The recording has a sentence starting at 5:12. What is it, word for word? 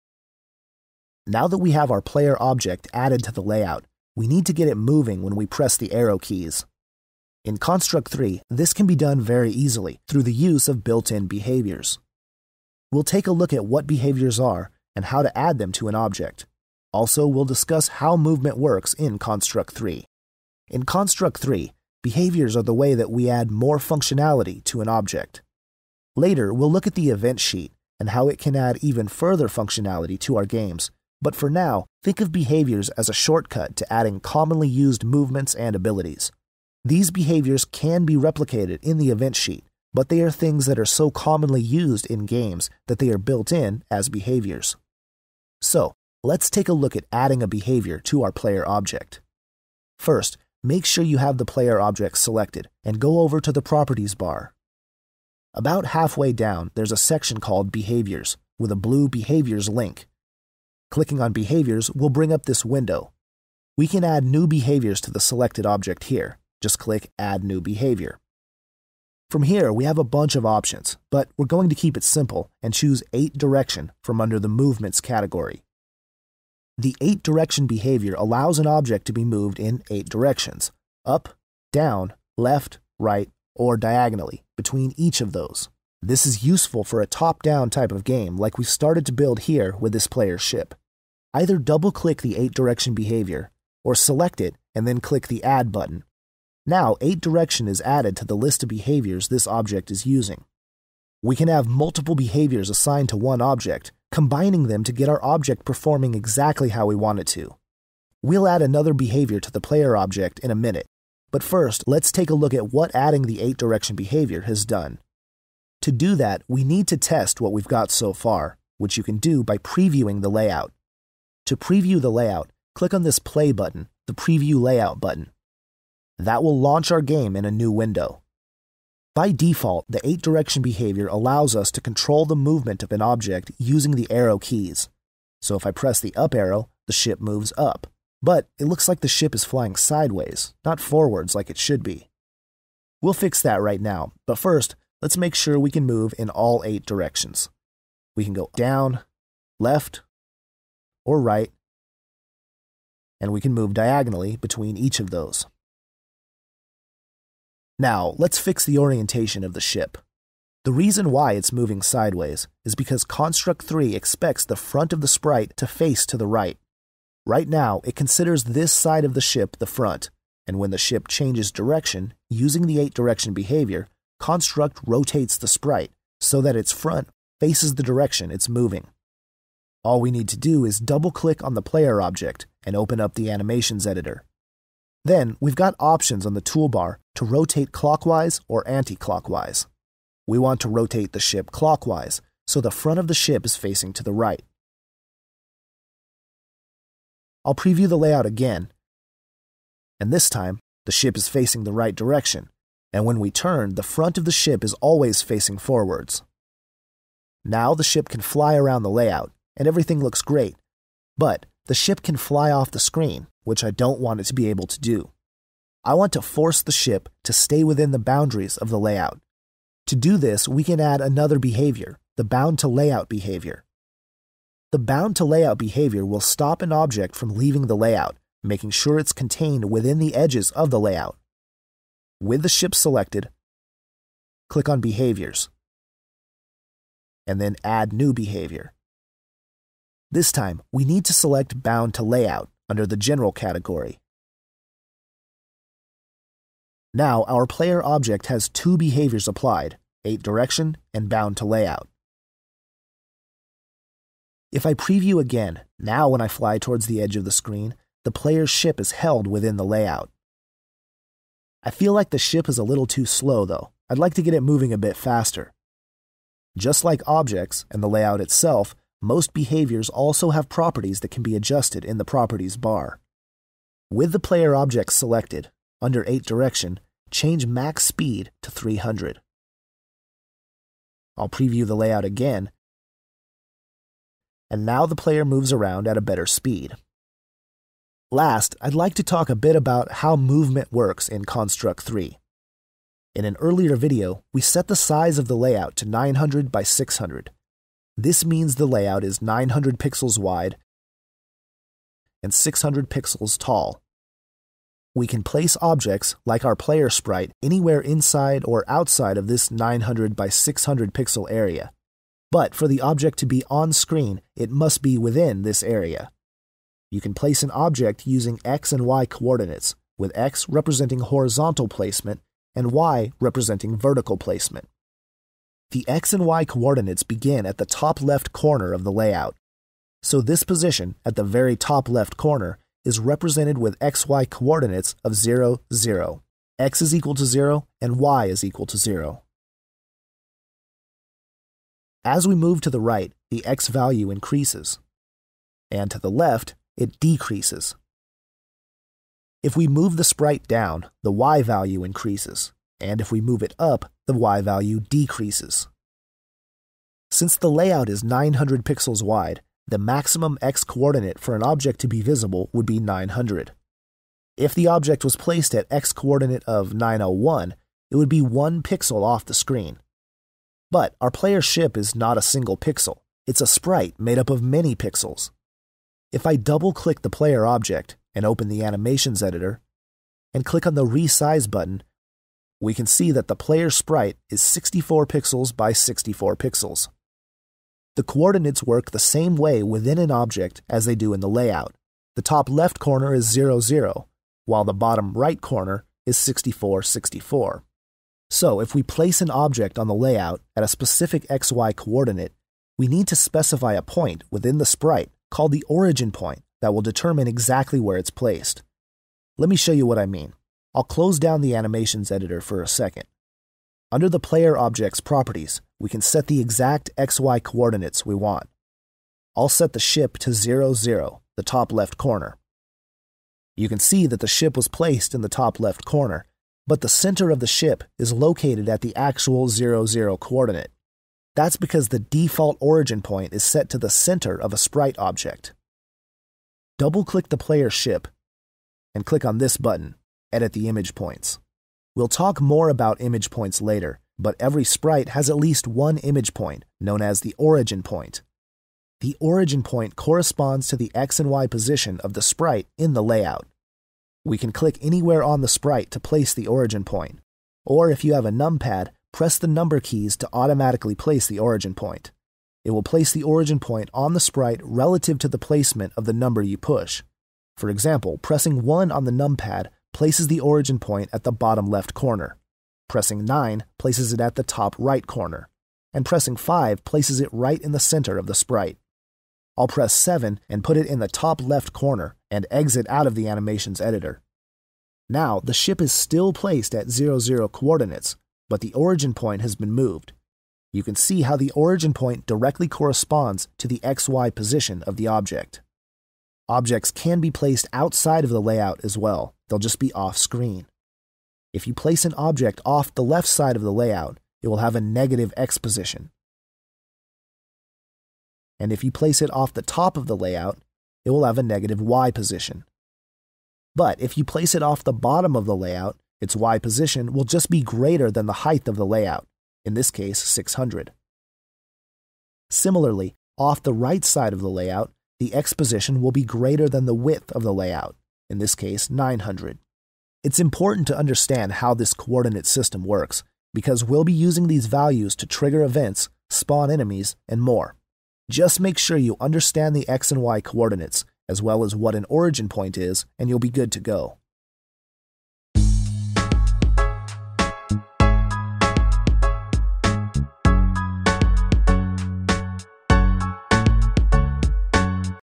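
But for the object to be on screen, it must be within this area.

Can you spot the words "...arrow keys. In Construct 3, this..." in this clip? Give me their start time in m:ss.
0:05.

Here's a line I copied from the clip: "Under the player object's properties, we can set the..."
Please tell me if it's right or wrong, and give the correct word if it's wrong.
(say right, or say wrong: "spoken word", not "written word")
right.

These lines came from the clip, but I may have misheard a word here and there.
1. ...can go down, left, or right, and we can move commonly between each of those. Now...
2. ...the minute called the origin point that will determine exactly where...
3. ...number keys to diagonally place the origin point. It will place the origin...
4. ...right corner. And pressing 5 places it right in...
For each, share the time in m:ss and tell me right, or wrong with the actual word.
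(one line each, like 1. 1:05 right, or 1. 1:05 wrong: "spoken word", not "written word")
1. 2:28 wrong: "diagonally", not "commonly"
2. 6:44 wrong: "sprite", not "minute"
3. 7:39 wrong: "automatically", not "diagonally"
4. 7:54 right.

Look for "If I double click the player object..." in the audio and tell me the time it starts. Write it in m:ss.
6:16.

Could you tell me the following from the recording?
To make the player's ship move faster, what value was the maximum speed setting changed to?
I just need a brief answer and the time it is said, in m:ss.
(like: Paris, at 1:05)
300, at 4:38.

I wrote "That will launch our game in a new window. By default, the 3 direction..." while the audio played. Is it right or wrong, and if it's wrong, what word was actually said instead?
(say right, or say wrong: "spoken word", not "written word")
wrong: "8", not "3".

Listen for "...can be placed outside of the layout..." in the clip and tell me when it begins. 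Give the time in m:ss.
8:16.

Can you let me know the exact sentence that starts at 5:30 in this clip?
So this position, at the very top left corner, is represented with XY coordinates of 0, 0.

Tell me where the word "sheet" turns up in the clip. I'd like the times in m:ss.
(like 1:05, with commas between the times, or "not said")
0:27, 0:39.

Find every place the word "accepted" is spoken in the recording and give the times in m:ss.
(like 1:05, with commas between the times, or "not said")
not said.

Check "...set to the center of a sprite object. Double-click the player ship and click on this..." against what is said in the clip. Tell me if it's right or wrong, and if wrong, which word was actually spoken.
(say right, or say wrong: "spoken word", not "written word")
right.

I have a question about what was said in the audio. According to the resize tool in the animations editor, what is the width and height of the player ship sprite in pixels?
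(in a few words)
64 by 64.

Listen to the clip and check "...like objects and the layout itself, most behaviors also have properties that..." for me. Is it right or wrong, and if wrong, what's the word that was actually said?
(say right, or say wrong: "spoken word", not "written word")
right.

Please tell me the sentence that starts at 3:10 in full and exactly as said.
We want to rotate the ship clockwise, so the front of the ship is facing to the right.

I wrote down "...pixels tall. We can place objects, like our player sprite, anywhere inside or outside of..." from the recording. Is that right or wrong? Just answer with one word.
right.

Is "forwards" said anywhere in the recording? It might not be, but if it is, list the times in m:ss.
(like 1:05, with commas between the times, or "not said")
2:20, 3:25.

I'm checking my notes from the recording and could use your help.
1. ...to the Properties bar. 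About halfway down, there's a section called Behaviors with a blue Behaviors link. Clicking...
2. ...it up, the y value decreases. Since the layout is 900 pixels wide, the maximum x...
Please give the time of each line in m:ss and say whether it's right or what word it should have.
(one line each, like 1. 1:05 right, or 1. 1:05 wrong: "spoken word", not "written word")
1. 0:53 right
2. 5:53 right.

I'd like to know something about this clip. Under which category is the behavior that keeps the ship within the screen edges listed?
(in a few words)
General.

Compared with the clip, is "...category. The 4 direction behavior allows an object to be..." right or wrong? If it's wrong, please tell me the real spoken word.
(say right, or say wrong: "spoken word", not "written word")
wrong: "8", not "4".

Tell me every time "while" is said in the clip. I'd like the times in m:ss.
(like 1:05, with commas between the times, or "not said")
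6:34.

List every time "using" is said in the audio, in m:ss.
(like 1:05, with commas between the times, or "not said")
1:40, 2:13, 2:52, 5:18, 8:54.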